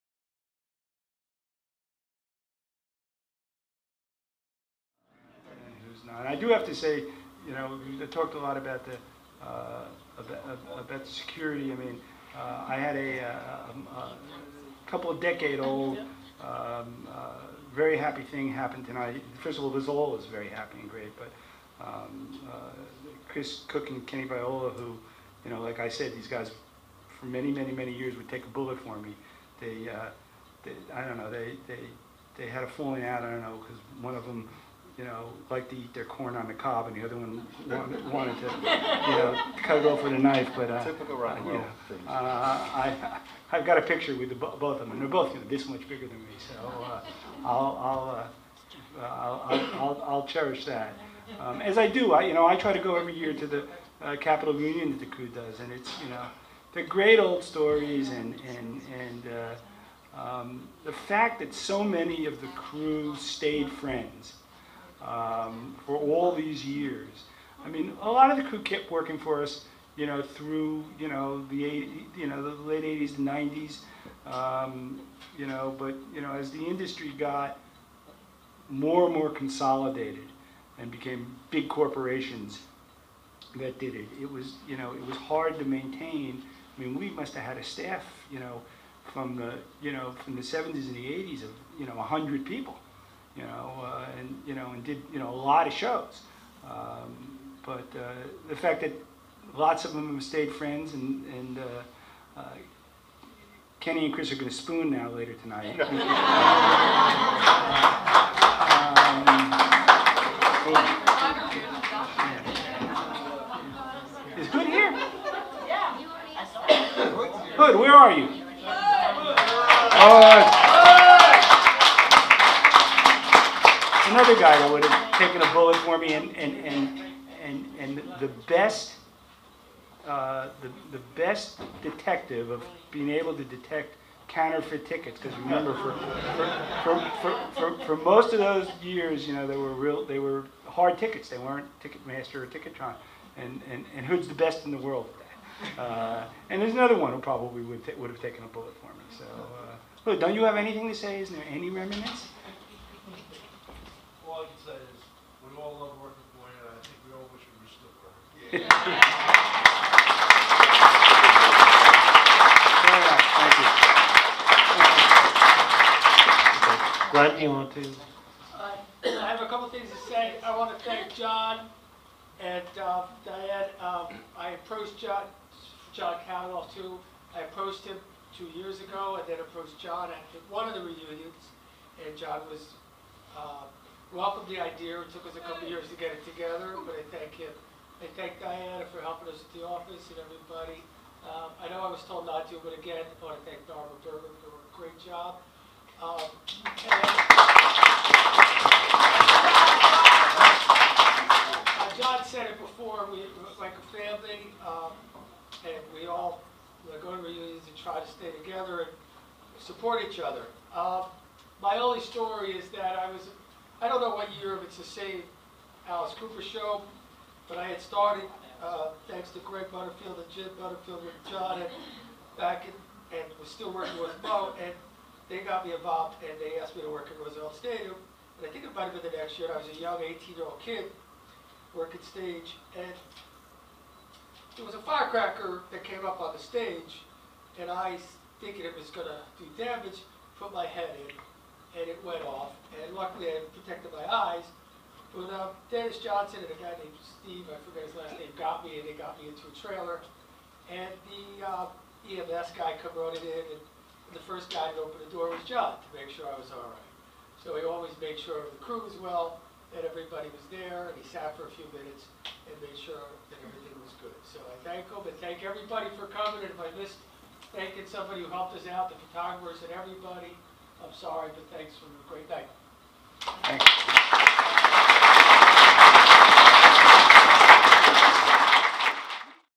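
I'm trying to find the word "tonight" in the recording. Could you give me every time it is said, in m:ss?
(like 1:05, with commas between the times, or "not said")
0:18, 1:45.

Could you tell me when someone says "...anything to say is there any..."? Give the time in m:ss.
2:30.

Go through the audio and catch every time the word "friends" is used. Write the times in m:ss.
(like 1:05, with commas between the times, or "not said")
1:03, 1:40.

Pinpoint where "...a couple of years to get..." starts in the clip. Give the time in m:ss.
3:05.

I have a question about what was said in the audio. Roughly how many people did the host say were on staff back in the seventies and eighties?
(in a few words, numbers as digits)
100.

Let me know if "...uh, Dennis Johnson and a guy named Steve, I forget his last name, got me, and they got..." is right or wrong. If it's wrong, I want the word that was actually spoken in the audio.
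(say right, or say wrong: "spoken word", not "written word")
right.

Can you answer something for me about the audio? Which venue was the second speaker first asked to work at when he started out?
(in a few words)
Roosevelt Stadium.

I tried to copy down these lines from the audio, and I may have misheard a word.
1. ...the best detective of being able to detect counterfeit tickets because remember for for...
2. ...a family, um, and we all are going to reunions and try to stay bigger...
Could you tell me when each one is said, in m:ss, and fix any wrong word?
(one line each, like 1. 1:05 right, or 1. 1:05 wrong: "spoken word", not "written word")
1. 2:10 right
2. 3:23 wrong: "together", not "bigger".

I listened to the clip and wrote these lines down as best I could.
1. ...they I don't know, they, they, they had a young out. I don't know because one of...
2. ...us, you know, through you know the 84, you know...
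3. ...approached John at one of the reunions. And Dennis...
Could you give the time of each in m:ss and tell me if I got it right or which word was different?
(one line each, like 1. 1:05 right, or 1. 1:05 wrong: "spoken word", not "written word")
1. 0:30 wrong: "falling", not "young"
2. 1:09 wrong: "80", not "84"
3. 2:59 wrong: "John", not "Dennis".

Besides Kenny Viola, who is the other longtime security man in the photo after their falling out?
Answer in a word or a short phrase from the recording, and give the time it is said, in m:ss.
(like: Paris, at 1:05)
Chris Cook, at 0:23.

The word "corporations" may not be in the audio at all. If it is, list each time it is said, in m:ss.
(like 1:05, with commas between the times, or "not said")
1:21.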